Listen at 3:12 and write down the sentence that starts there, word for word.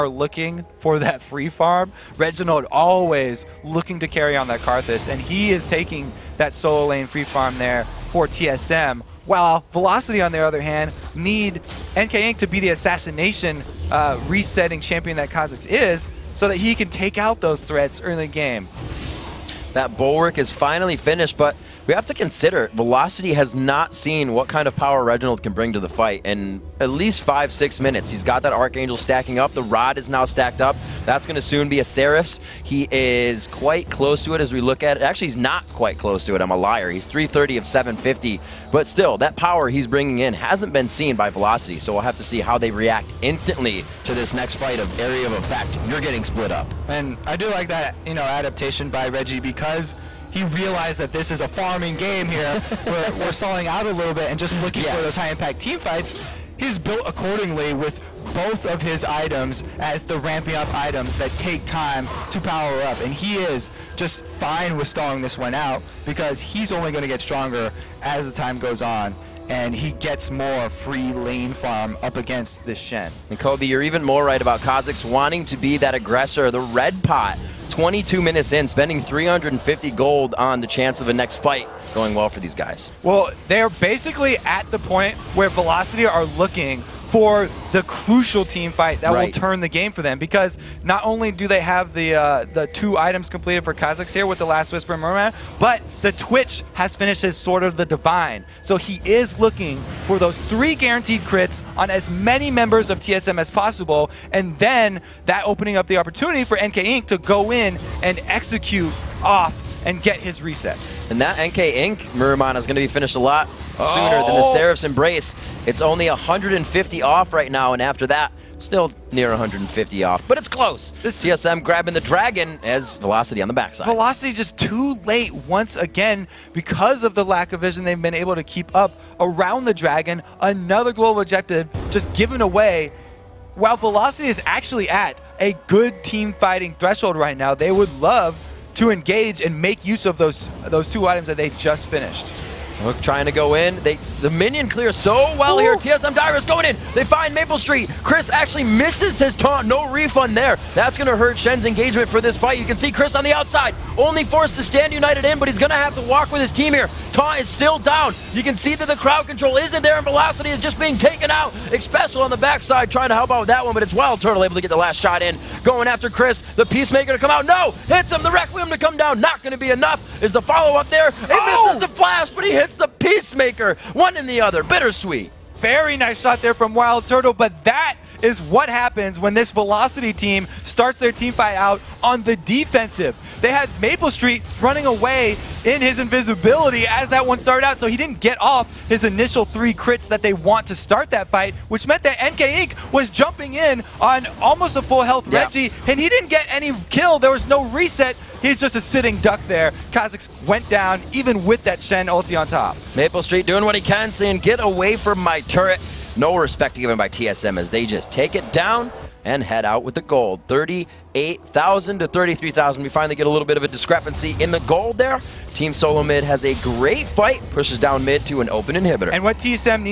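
was jumping in on almost a full health yeah.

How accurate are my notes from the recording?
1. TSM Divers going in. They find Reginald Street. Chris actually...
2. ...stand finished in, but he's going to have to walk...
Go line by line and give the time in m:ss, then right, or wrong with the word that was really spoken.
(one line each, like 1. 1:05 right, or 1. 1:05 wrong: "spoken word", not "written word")
1. 2:25 wrong: "Maple", not "Reginald"
2. 2:34 wrong: "united", not "finished".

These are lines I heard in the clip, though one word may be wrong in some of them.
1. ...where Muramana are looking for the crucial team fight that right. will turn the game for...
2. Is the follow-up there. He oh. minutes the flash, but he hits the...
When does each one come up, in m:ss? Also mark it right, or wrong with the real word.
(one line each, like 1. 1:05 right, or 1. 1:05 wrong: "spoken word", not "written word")
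1. 1:25 wrong: "Velocity", not "Muramana"
2. 2:50 wrong: "misses", not "minutes".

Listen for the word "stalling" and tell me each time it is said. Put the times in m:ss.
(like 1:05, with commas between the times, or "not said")
0:53, 1:04.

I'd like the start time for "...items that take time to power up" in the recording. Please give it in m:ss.
1:00.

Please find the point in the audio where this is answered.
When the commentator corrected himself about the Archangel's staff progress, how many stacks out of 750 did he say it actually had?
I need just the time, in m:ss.
0:37.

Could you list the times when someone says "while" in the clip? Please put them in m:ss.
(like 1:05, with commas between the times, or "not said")
0:09, 2:13.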